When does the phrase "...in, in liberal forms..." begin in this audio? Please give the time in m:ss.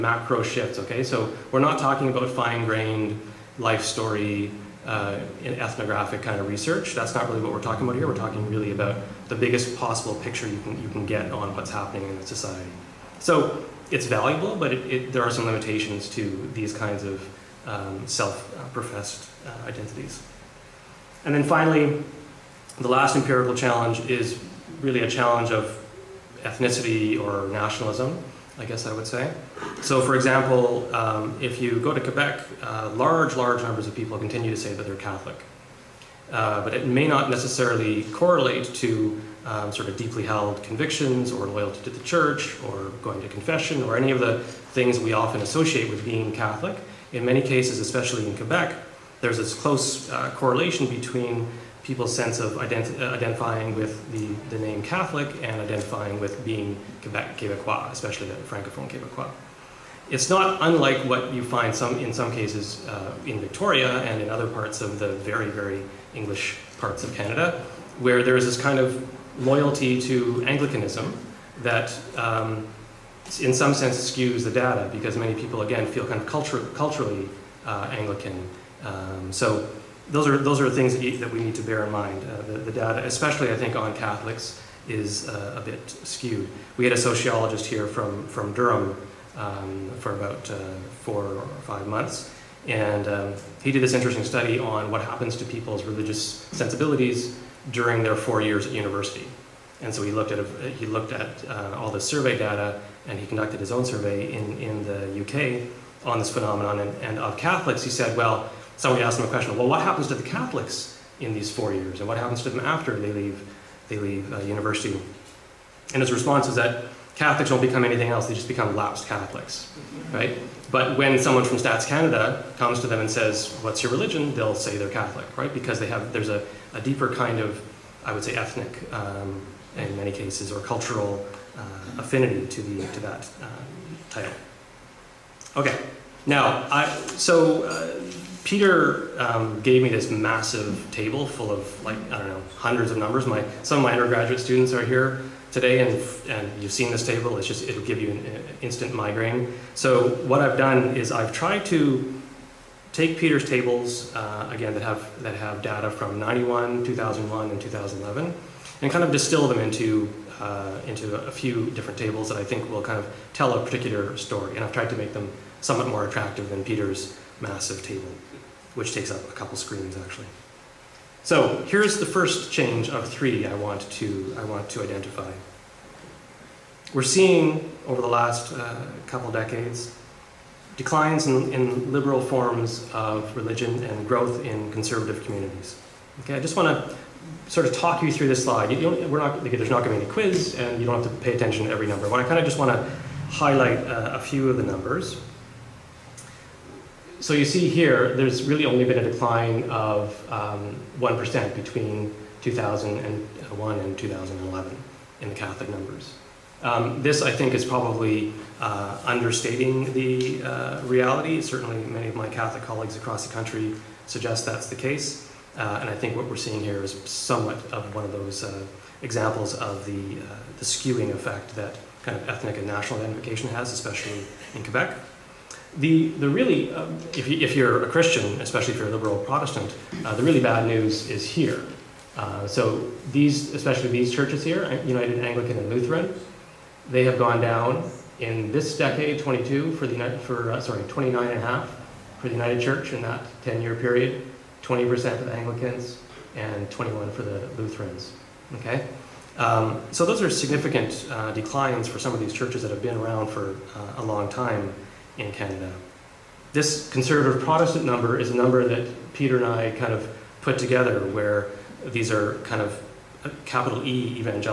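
3:01.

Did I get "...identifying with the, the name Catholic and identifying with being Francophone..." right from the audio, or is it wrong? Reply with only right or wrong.
wrong.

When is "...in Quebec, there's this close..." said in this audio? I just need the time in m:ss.
0:48.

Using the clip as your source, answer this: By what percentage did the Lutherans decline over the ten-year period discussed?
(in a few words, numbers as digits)
21%.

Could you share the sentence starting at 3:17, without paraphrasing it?
So you see here, there's really only been a decline of 1% um, between 2001 and 2011 in the Catholic numbers.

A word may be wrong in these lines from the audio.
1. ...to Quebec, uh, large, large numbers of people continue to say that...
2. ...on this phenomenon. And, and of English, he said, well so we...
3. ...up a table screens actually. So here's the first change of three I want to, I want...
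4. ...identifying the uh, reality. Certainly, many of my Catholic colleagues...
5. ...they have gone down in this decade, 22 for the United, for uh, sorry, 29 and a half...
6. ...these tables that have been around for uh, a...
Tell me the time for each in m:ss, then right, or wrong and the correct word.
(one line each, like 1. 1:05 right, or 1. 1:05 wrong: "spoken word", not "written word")
1. 0:31 right
2. 1:46 wrong: "Catholics", not "English"
3. 2:49 wrong: "couple", not "table"
4. 3:29 wrong: "understating", not "identifying"
5. 3:56 right
6. 4:12 wrong: "churches", not "tables".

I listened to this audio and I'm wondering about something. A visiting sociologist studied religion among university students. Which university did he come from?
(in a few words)
Durham.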